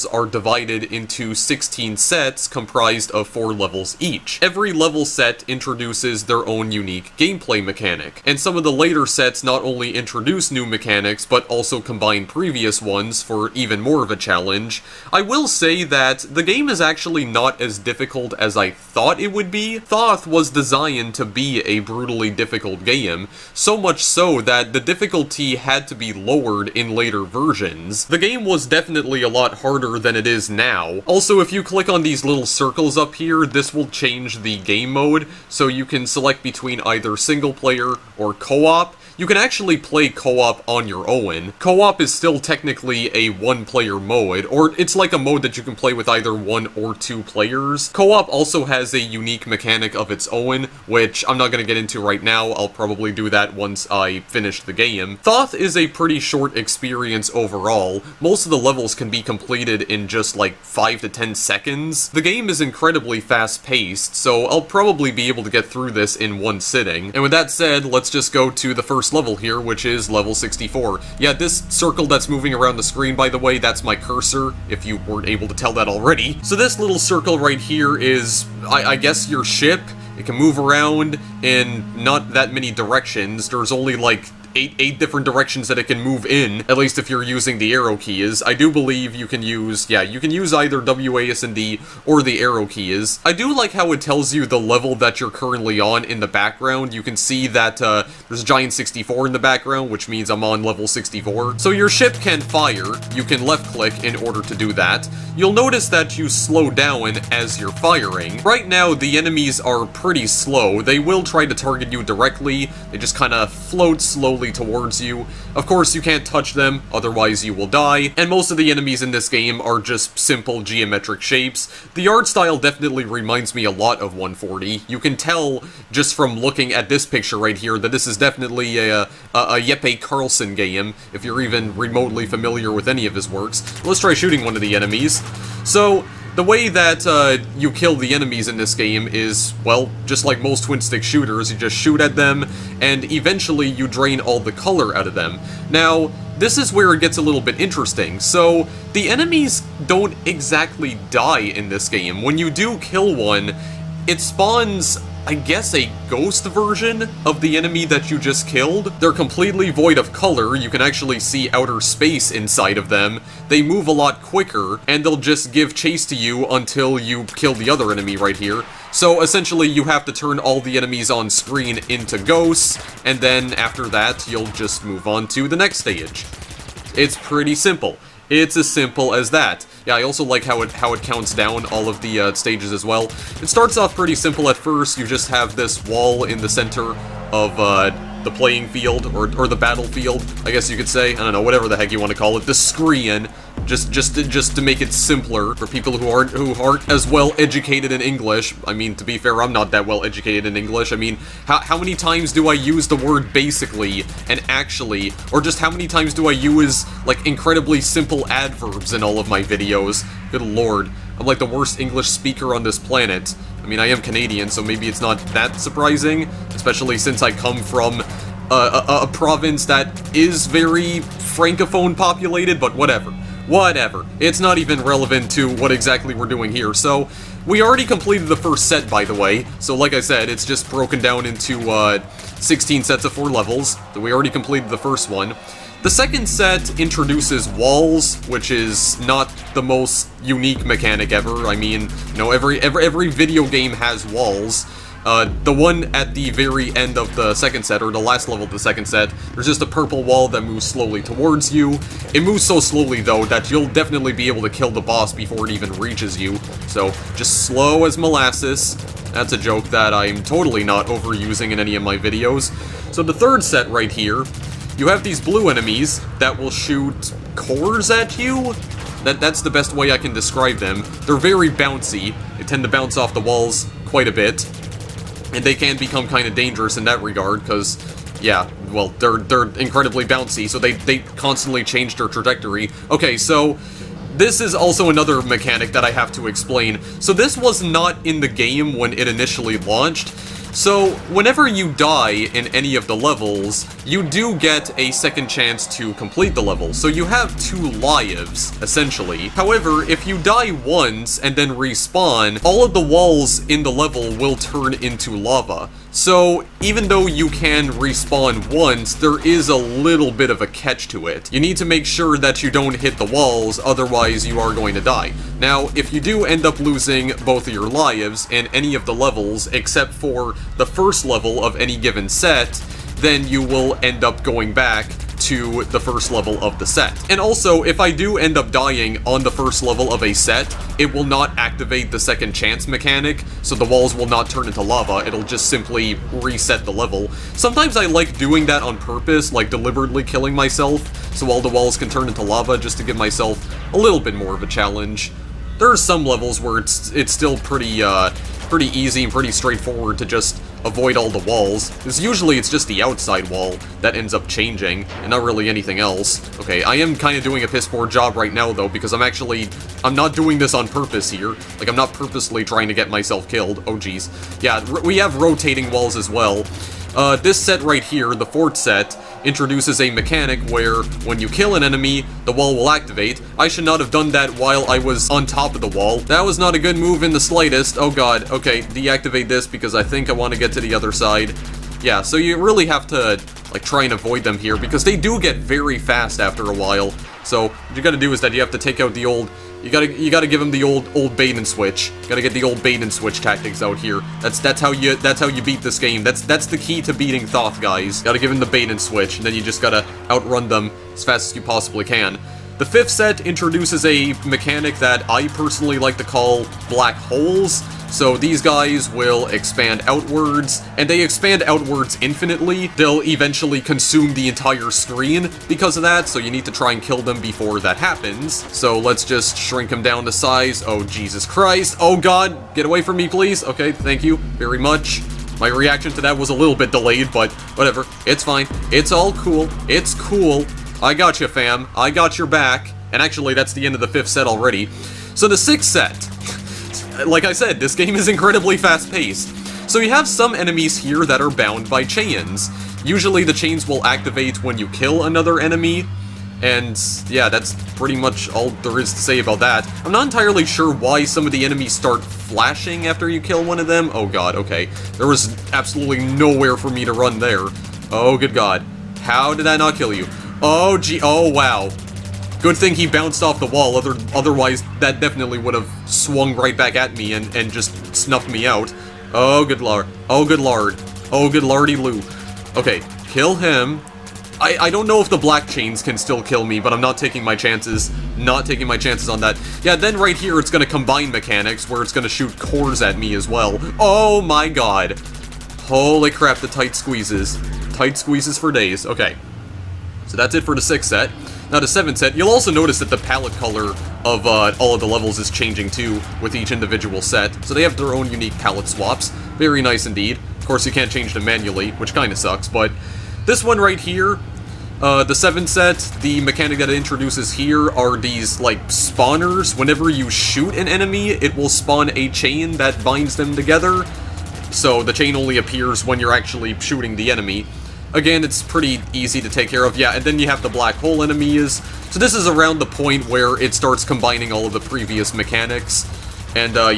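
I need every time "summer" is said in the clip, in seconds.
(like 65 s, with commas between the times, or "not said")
not said.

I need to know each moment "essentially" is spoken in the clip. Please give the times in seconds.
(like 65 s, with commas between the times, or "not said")
169 s, 298 s.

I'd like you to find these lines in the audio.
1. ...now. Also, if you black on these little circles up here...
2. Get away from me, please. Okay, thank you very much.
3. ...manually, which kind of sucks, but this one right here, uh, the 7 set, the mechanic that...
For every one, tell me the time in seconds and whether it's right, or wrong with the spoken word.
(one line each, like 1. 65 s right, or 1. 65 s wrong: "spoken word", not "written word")
1. 30 s wrong: "click", not "black"
2. 422 s right
3. 501 s right.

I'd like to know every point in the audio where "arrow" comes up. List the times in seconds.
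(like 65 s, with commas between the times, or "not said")
87 s, 92 s.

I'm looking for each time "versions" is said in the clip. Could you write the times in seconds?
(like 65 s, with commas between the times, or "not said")
27 s, 156 s.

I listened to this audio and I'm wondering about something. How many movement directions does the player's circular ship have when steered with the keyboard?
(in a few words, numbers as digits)
eight.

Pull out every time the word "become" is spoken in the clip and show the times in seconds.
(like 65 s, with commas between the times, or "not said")
275 s.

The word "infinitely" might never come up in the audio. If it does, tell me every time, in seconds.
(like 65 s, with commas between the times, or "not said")
412 s.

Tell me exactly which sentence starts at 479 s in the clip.
Yeah, then right here it's gonna combine mechanics, where it's gonna shoot cores at me as well.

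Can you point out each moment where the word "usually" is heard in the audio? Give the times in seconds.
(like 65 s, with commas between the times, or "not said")
351 s, 442 s.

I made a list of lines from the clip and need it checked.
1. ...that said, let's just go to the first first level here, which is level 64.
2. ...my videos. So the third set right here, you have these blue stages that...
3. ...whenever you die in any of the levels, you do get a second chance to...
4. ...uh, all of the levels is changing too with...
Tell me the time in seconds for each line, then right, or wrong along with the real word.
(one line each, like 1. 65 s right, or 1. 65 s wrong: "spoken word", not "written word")
1. 67 s right
2. 261 s wrong: "enemies", not "stages"
3. 291 s right
4. 494 s right.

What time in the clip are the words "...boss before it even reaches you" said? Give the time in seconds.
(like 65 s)
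254 s.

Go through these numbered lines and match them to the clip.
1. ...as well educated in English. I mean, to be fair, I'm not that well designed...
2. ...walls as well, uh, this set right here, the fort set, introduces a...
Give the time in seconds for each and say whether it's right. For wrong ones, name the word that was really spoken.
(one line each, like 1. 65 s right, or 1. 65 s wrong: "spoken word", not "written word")
1. 196 s wrong: "educated", not "designed"
2. 365 s right.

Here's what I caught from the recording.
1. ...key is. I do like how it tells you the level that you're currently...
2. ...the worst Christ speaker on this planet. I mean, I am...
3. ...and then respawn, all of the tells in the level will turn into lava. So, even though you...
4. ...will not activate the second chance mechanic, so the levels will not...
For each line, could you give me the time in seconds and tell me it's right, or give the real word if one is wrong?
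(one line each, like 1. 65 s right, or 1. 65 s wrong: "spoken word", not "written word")
1. 92 s right
2. 211 s wrong: "English", not "Christ"
3. 301 s wrong: "walls", not "tells"
4. 330 s wrong: "walls", not "levels".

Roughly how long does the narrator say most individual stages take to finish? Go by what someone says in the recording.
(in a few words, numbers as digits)
5 to 10 seconds.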